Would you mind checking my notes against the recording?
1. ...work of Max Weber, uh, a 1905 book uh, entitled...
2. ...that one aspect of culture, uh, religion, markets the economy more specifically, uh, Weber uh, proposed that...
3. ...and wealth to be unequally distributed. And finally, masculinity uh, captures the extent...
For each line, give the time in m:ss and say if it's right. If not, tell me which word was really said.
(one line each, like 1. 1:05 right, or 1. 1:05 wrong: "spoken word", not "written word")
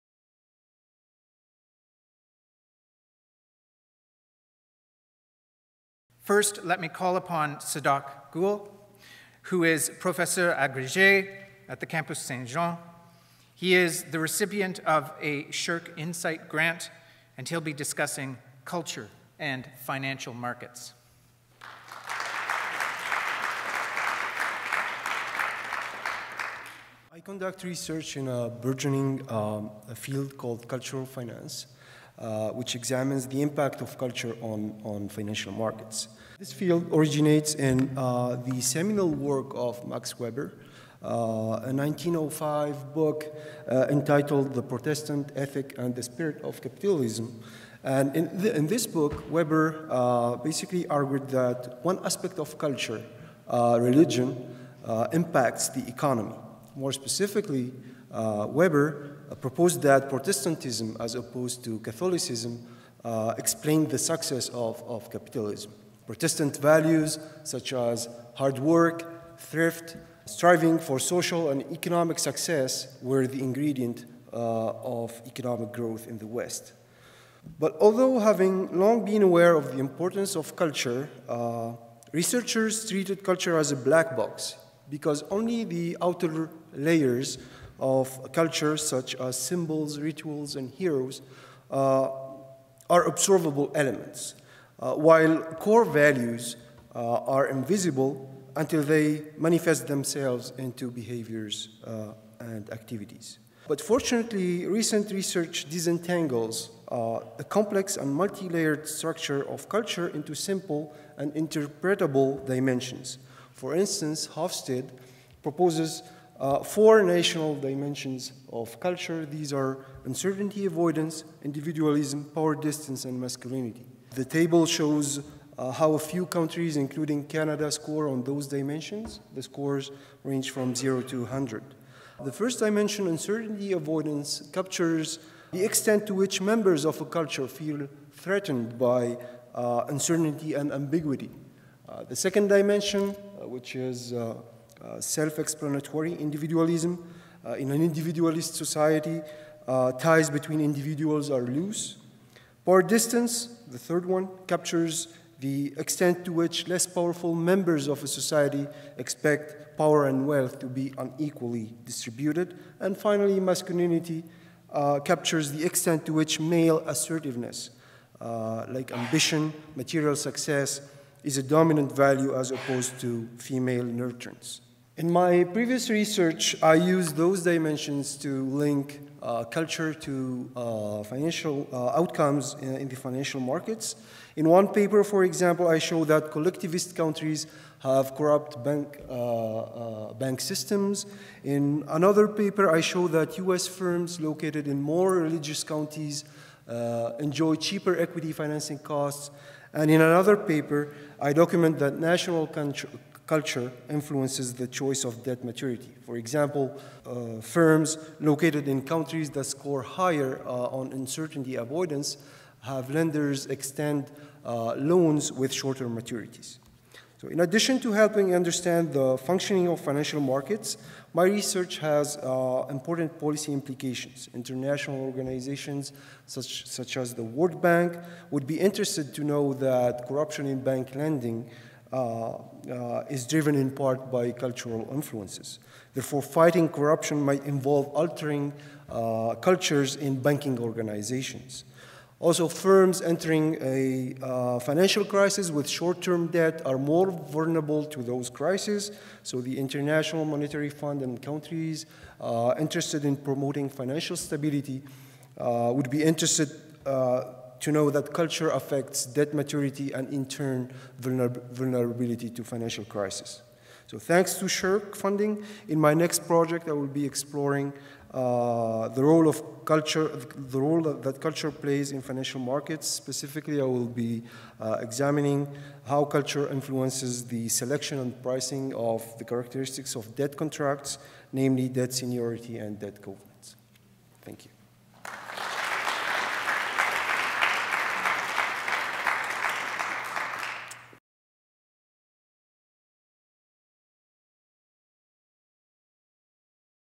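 1. 0:39 right
2. 0:51 wrong: "impacts", not "markets"
3. 2:40 right.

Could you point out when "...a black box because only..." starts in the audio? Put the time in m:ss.
1:23.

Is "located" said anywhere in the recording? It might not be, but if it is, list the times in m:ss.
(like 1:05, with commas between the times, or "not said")
3:14, 3:28.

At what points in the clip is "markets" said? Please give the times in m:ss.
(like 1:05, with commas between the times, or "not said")
0:20, 0:35, 3:03, 3:40, 4:32.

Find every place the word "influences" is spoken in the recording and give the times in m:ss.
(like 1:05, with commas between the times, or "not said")
3:23, 3:54, 4:36.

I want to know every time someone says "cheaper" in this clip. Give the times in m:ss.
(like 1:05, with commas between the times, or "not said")
3:17.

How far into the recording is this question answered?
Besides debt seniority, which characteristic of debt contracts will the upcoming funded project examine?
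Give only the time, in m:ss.
4:42.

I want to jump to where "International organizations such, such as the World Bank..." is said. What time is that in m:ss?
3:44.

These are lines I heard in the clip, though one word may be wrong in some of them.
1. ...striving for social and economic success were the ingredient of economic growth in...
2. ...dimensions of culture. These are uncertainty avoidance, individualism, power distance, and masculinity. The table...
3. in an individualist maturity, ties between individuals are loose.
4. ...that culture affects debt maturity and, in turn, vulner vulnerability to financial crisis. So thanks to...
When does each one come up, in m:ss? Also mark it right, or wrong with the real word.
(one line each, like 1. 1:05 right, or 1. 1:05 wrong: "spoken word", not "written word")
1. 1:10 right
2. 1:57 right
3. 2:27 wrong: "society", not "maturity"
4. 4:17 right.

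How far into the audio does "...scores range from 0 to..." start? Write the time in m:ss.
2:09.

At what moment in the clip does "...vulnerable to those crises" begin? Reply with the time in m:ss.
4:07.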